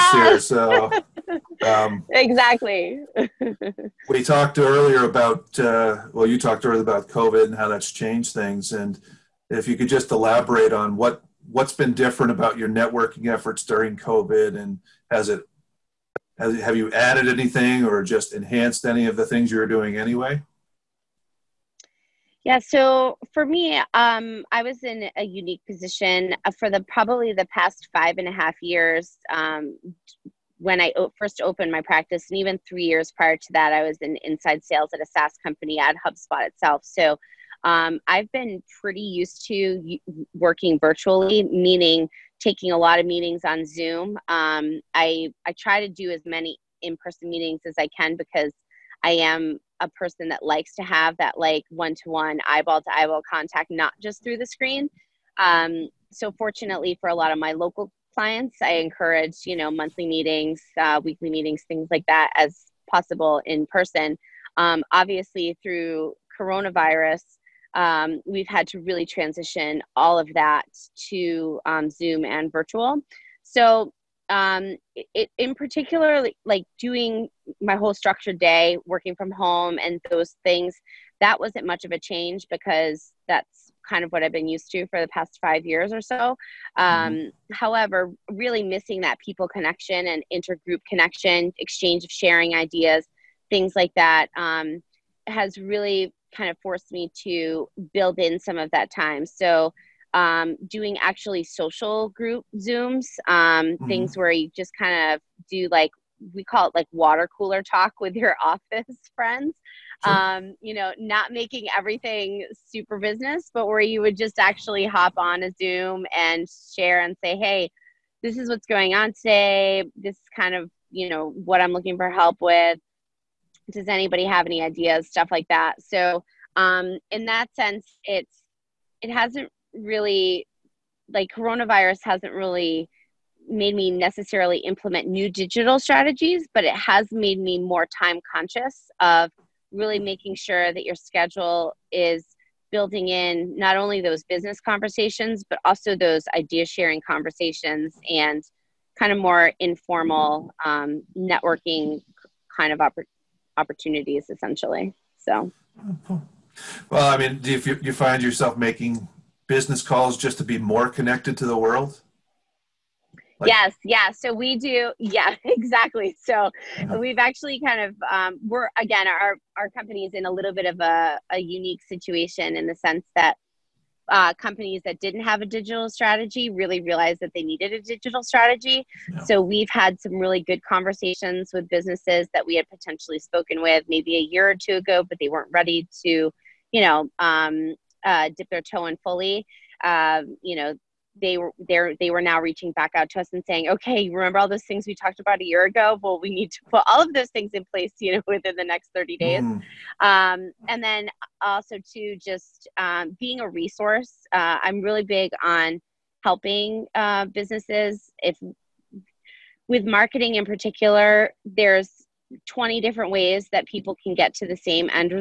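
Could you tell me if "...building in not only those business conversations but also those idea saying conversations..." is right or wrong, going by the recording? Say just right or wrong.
wrong.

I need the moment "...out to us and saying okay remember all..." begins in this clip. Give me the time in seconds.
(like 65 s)
192 s.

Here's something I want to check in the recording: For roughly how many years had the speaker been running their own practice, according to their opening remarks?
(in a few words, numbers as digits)
5 and a half years.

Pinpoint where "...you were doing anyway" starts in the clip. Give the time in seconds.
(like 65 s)
19 s.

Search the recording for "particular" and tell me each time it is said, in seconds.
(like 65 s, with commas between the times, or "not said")
75 s, 210 s.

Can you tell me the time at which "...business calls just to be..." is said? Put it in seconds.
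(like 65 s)
159 s.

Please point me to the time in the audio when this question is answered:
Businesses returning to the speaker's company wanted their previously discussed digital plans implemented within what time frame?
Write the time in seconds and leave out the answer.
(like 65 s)
198 s.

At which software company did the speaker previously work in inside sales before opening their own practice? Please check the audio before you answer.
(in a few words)
HubSpot.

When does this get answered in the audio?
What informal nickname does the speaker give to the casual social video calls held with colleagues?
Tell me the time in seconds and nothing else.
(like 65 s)
106 s.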